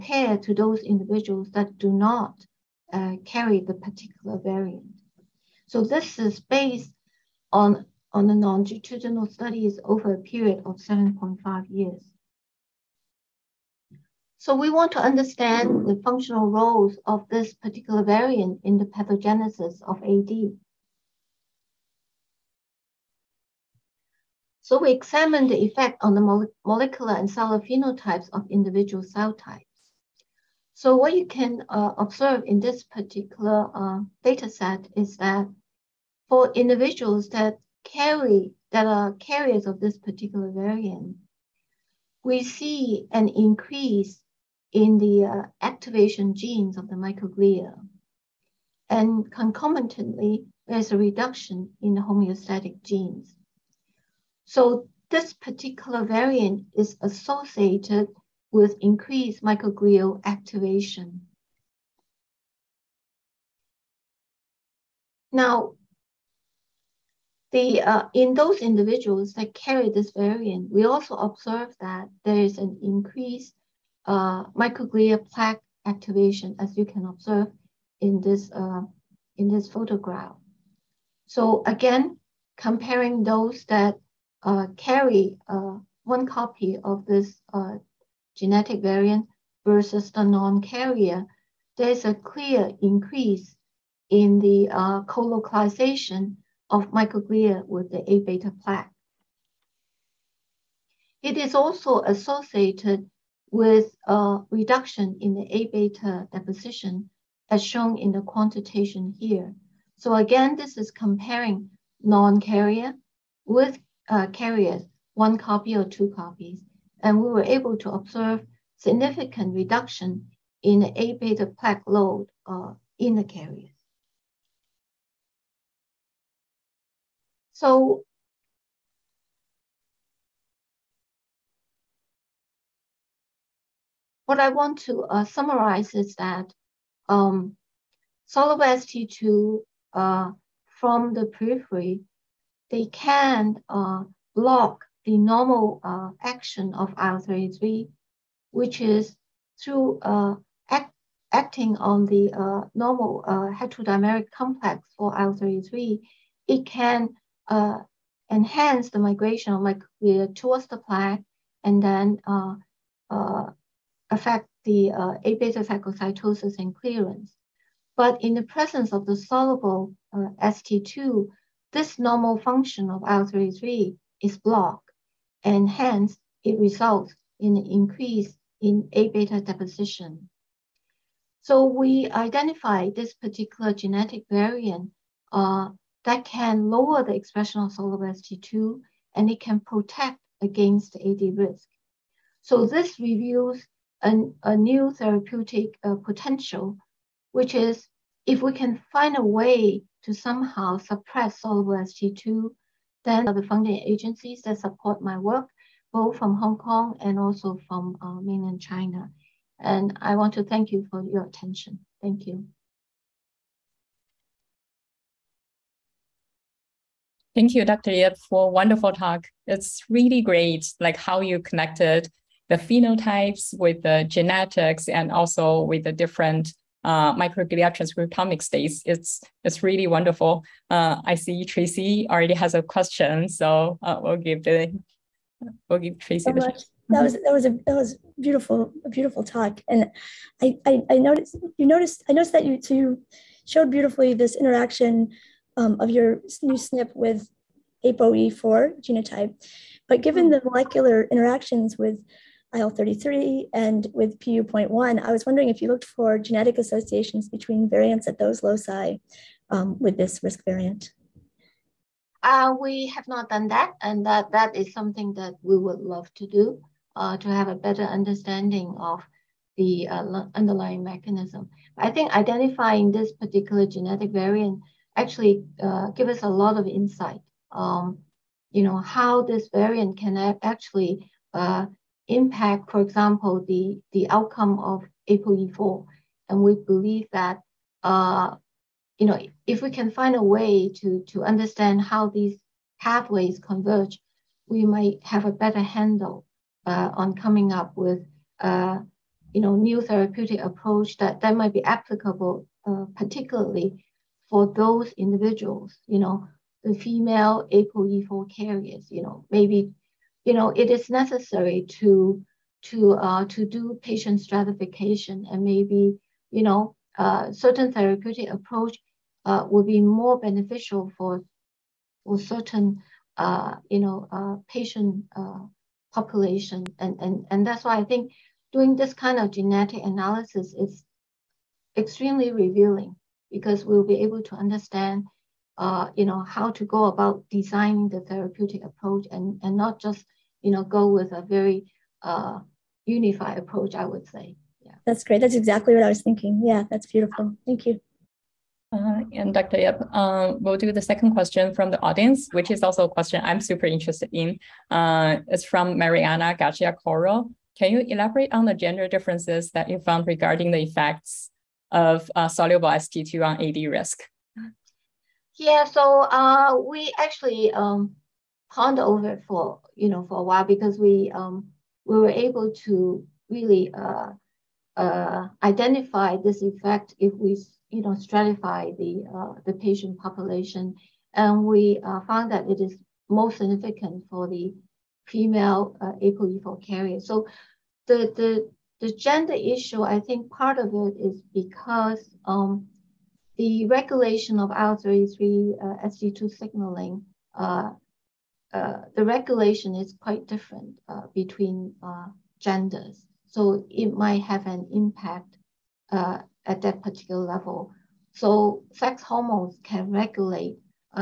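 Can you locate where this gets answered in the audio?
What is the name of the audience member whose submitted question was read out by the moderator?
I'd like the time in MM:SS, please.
05:55.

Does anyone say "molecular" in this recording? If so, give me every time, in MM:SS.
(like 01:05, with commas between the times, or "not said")
00:26, 04:10.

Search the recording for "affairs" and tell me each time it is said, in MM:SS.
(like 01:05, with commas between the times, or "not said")
not said.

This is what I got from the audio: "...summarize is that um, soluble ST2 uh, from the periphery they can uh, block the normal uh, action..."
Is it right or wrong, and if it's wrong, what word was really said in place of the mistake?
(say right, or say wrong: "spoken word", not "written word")
right.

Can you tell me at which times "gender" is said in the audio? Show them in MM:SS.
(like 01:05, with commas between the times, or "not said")
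05:58, 06:28, 06:42.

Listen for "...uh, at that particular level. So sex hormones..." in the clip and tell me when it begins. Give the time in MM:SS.
06:45.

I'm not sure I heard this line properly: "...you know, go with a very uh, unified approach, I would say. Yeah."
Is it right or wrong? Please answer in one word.
right.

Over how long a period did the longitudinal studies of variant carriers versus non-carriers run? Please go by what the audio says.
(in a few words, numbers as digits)
7.5 years.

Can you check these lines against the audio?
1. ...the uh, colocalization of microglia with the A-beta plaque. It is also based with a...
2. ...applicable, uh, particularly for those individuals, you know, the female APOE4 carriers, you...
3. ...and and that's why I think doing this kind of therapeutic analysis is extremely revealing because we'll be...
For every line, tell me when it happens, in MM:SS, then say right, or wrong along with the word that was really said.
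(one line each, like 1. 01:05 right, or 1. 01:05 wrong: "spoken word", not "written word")
1. 01:34 wrong: "associated", not "based"
2. 05:01 right
3. 05:27 wrong: "genetic", not "therapeutic".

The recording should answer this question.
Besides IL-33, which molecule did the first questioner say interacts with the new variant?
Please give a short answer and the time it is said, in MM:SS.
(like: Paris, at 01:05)
PU.1, at 04:14.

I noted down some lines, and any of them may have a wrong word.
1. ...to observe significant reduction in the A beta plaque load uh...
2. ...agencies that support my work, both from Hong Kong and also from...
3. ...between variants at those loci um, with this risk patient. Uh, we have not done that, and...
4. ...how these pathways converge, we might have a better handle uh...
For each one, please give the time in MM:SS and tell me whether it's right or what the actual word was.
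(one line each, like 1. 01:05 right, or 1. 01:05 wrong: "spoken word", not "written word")
1. 01:57 right
2. 03:23 right
3. 04:17 wrong: "variant", not "patient"
4. 04:51 right.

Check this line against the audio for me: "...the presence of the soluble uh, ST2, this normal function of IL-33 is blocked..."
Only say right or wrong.
right.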